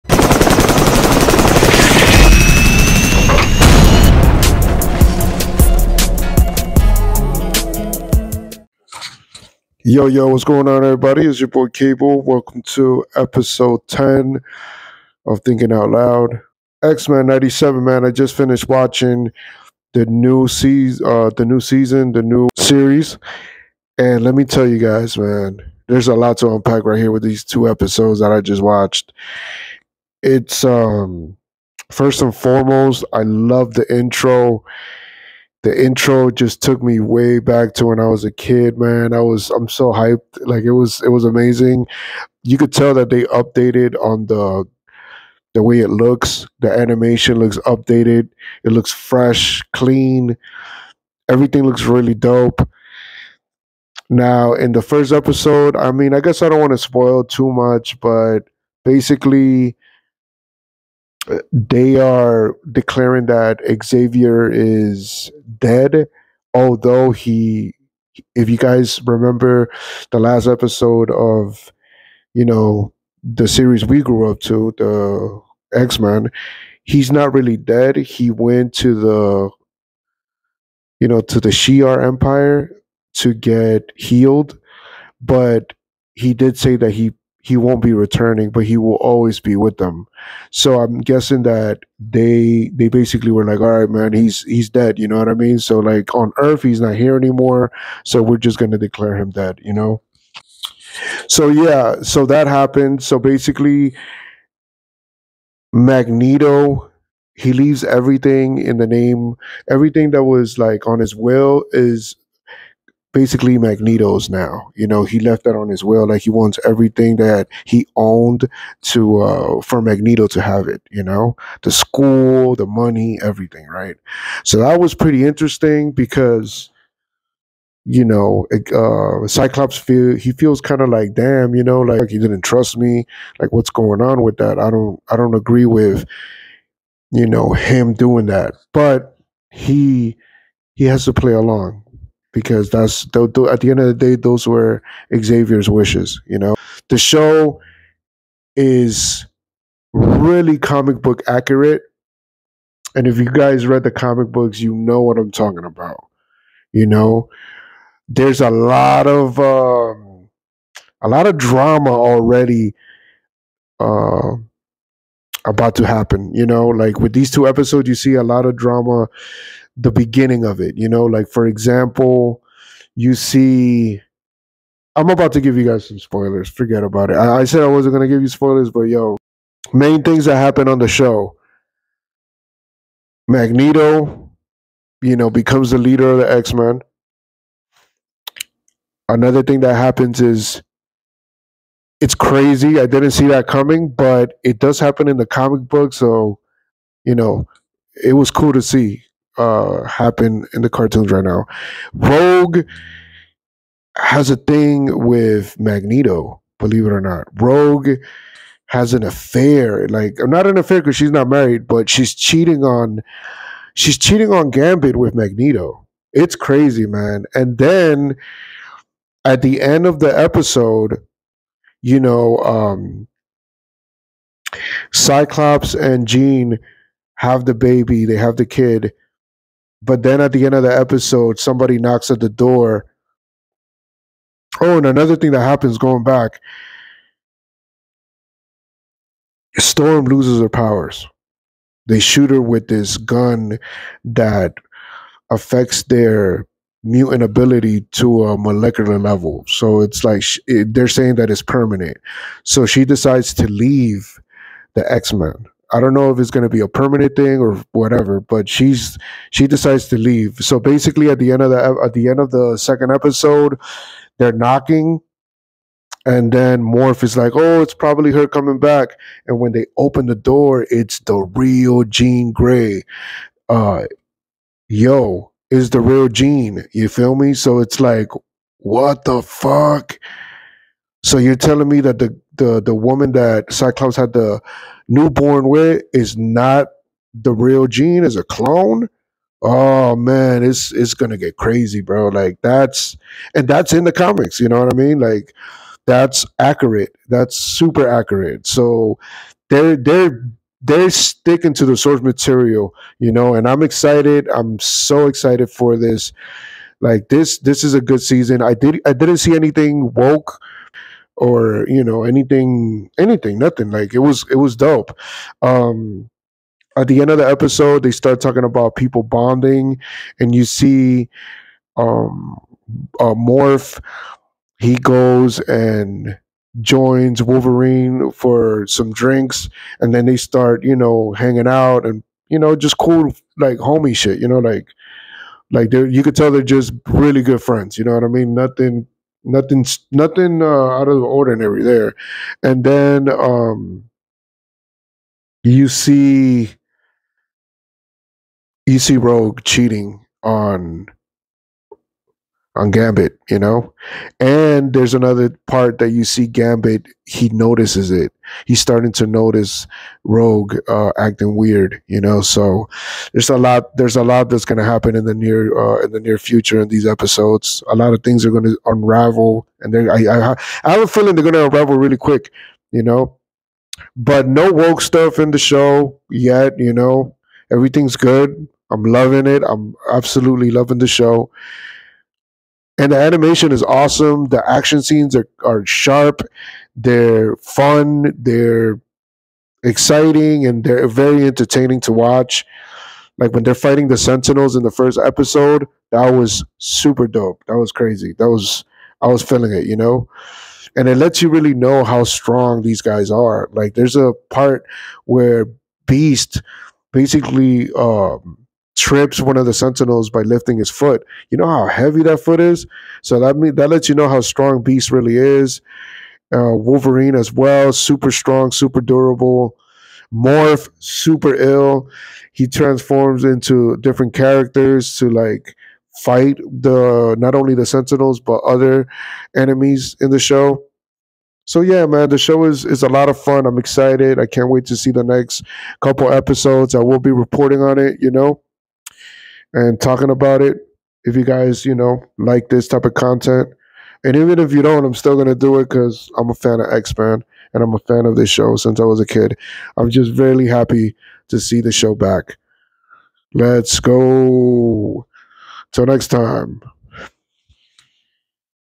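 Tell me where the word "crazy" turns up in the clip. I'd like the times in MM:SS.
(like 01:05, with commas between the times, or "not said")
03:12, 03:36, 04:51, 06:37.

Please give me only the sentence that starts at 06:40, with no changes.
And it lets you really know how strong these guys are.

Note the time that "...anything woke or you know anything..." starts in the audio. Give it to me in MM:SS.
05:09.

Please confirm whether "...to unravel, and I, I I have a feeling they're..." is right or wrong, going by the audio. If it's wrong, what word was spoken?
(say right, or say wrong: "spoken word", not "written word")
right.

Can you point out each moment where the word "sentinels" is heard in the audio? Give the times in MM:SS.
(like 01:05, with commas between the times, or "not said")
06:33, 06:49, 07:07.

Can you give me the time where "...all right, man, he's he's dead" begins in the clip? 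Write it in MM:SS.
01:33.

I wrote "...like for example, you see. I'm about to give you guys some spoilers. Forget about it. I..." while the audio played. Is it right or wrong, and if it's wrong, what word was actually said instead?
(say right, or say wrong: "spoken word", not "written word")
right.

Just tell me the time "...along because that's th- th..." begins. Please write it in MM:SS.
02:21.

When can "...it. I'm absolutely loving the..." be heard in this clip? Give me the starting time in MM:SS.
06:19.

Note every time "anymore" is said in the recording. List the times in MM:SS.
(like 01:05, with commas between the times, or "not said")
01:37.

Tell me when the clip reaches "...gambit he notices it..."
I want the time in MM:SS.
05:56.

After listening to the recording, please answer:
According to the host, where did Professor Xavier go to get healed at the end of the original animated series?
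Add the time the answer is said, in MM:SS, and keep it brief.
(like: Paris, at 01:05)
the Shi'ar Empire, at 01:21.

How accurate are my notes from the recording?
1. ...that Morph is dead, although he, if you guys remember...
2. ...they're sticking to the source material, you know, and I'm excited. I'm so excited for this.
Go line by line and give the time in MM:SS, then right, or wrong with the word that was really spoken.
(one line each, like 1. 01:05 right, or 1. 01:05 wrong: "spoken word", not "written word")
1. 01:03 wrong: "Xavier", not "Morph"
2. 05:00 right.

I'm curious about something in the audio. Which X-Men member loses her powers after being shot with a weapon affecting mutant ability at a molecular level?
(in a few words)
Storm.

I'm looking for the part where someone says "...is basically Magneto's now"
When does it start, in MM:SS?
01:51.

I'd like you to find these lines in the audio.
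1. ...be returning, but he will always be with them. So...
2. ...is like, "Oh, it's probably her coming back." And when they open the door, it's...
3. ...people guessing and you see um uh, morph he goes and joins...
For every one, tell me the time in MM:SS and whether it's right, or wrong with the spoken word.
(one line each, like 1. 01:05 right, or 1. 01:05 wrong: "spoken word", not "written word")
1. 01:27 right
2. 04:27 right
3. 05:18 wrong: "bonding", not "guessing".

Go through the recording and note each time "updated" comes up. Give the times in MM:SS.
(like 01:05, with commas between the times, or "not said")
00:43, 00:47.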